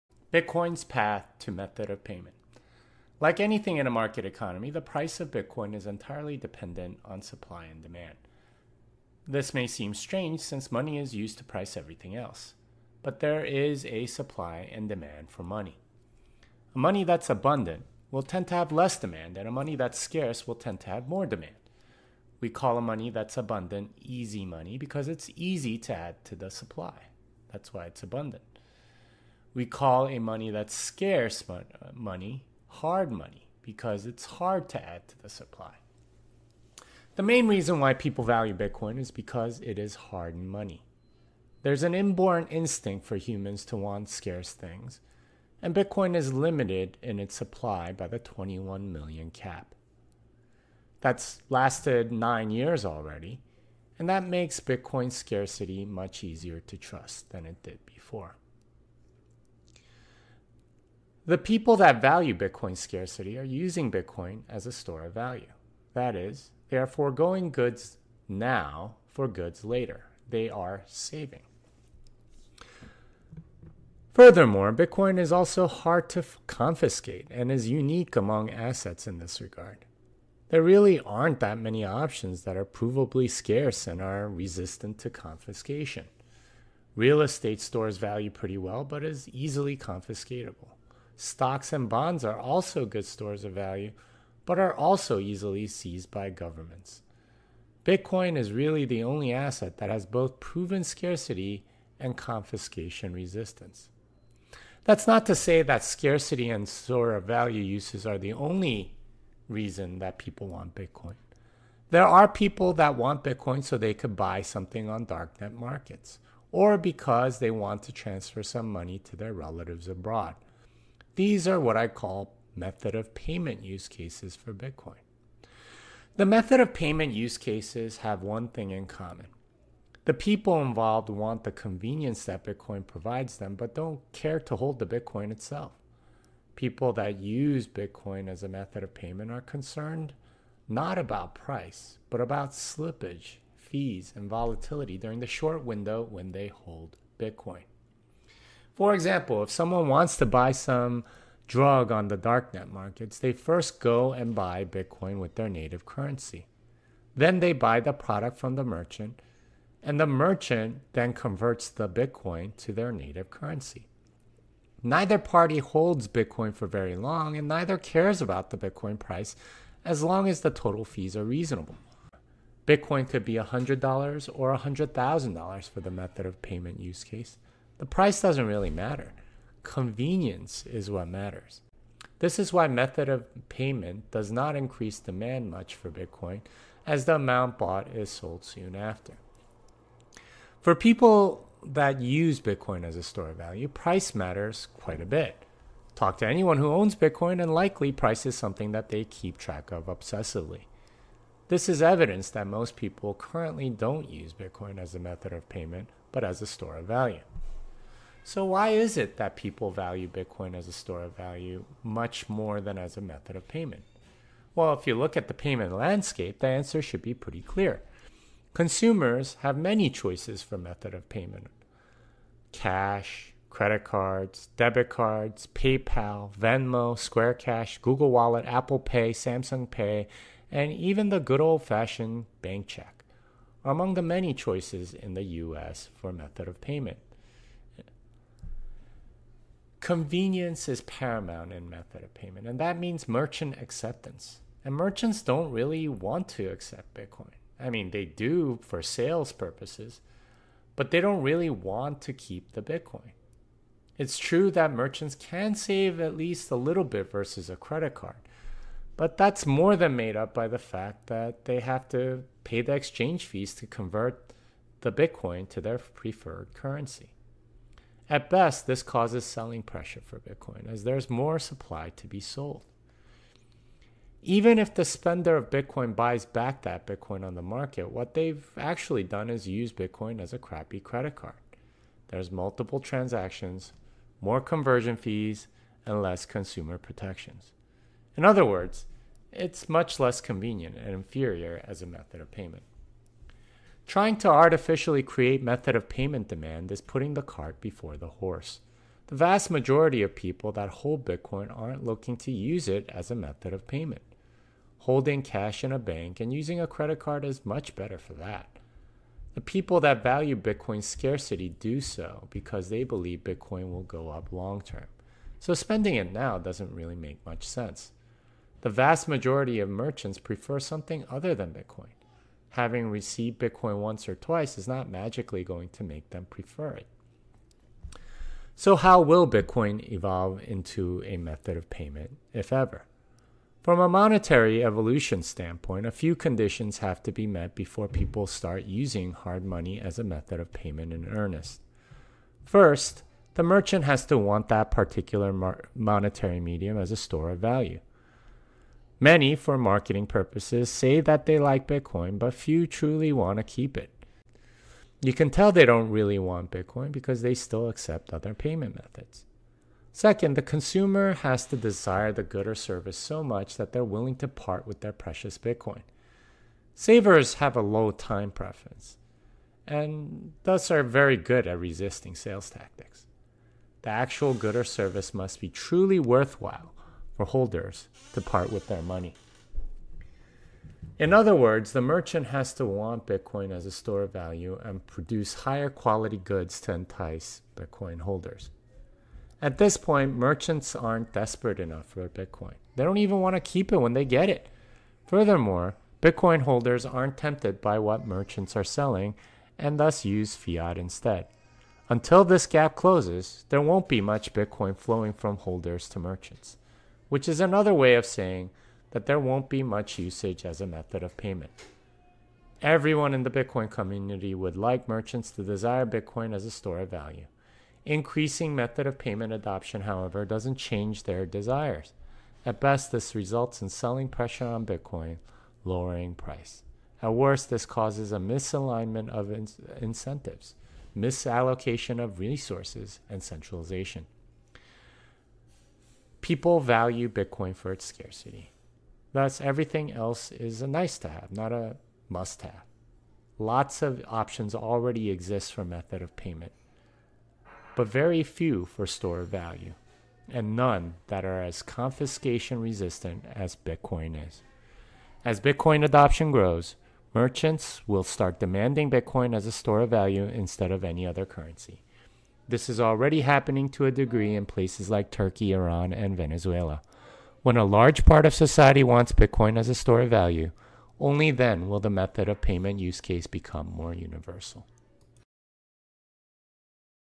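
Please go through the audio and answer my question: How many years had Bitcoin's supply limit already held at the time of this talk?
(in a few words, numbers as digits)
9.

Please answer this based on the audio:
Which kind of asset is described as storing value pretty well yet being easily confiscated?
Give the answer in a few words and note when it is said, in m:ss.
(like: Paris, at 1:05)
Real estate, at 1:26.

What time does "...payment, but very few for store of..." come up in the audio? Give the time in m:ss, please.
7:26.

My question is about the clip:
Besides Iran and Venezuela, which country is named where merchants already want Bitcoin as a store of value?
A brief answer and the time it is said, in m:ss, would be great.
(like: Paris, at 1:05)
Turkey, at 7:45.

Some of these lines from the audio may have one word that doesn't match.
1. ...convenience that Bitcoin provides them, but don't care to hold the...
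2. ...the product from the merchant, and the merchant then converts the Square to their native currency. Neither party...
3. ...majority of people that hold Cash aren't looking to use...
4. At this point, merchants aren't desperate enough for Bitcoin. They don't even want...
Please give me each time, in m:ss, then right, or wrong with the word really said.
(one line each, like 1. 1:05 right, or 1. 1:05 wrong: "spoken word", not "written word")
1. 2:11 right
2. 2:37 wrong: "Bitcoin", not "Square"
3. 4:59 wrong: "Bitcoin", not "Cash"
4. 6:29 right.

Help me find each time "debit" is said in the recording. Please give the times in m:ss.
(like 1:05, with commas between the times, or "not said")
3:44.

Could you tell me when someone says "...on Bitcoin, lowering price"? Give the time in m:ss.
7:04.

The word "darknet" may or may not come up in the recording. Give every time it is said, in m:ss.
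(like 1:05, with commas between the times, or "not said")
1:55, 2:32.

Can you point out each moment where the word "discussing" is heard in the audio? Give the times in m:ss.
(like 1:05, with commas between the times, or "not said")
not said.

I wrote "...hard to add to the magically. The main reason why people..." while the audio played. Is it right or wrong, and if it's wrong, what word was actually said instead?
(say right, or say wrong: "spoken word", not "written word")
wrong: "supply", not "magically".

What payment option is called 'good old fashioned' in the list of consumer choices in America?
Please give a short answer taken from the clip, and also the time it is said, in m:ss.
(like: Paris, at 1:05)
bank check, at 3:52.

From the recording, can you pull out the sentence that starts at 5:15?
So spending it now doesn't really make much sense.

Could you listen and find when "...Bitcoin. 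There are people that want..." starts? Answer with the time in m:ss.
1:50.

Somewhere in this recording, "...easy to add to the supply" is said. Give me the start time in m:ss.
0:25.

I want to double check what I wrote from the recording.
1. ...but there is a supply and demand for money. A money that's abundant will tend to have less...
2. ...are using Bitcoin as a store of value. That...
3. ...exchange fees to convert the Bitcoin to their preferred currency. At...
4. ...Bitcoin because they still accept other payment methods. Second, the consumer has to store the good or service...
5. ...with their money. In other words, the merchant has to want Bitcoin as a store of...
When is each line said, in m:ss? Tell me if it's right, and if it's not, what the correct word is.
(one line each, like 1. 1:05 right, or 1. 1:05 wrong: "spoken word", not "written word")
1. 0:13 right
2. 1:03 right
3. 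4:22 right
4. 5:56 wrong: "desire", not "store"
5. 6:18 right.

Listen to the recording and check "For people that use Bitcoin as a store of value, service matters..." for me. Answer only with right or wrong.
wrong.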